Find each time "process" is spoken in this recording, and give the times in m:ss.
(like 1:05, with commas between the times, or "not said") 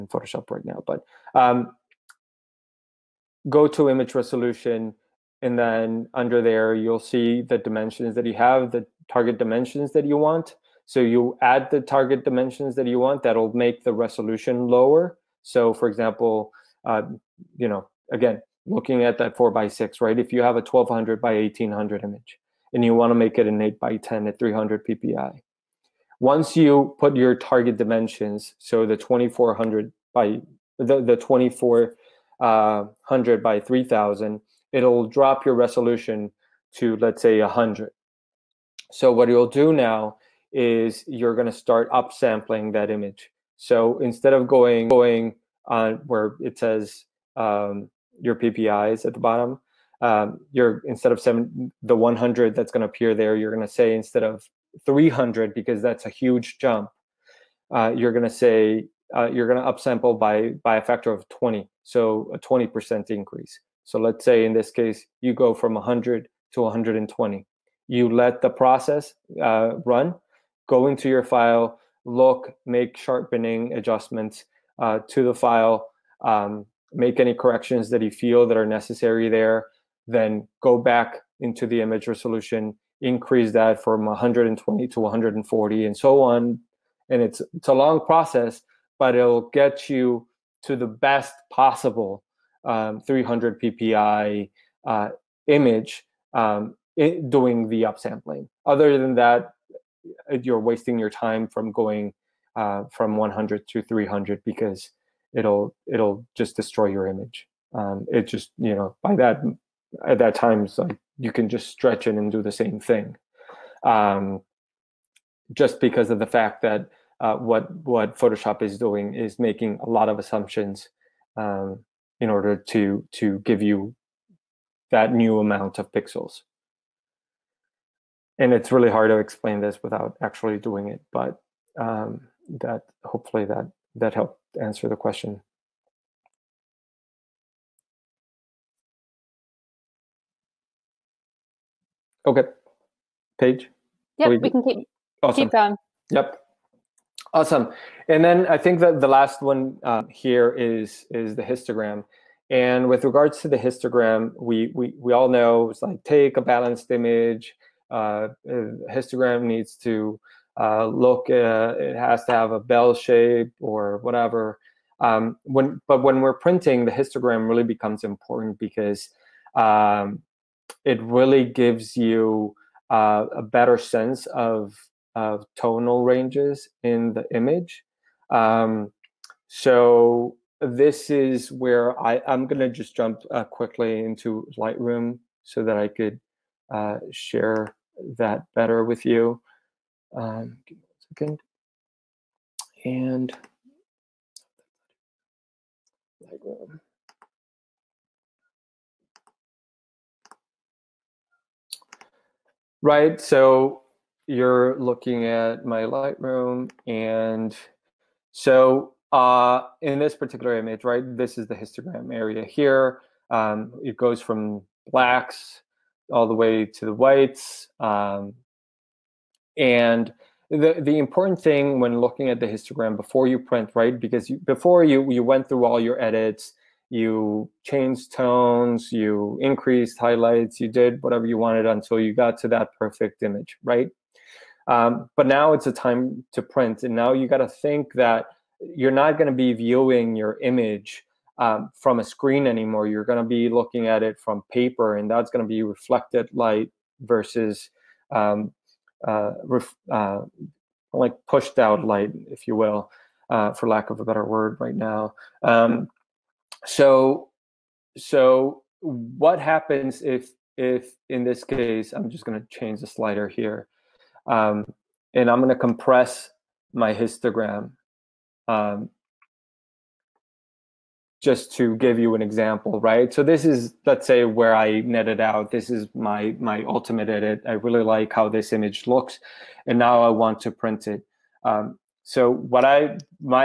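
1:08, 1:28.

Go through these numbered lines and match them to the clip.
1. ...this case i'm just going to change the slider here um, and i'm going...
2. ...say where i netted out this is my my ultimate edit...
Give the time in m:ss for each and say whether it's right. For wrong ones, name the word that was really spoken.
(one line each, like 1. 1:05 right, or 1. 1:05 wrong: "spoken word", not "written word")
1. 4:21 right
2. 4:34 right.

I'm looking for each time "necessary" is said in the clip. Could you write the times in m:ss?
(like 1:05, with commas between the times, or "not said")
1:18.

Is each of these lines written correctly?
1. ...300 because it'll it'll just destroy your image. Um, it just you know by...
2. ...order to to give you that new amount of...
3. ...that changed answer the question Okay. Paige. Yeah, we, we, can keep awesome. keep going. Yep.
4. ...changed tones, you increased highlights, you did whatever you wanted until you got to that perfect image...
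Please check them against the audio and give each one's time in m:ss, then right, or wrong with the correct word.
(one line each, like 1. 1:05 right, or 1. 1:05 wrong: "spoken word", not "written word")
1. 1:43 right
2. 2:02 right
3. 2:13 wrong: "helped", not "changed"
4. 3:47 right.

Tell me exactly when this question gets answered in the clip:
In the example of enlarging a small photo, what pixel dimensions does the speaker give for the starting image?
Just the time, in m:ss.
0:20.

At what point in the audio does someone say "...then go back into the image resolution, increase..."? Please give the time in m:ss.
1:20.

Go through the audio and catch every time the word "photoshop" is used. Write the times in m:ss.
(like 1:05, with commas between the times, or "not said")
0:00, 1:58.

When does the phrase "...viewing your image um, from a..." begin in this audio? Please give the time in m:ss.
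3:59.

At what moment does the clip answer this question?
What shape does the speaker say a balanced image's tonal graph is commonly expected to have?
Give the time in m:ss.
2:42.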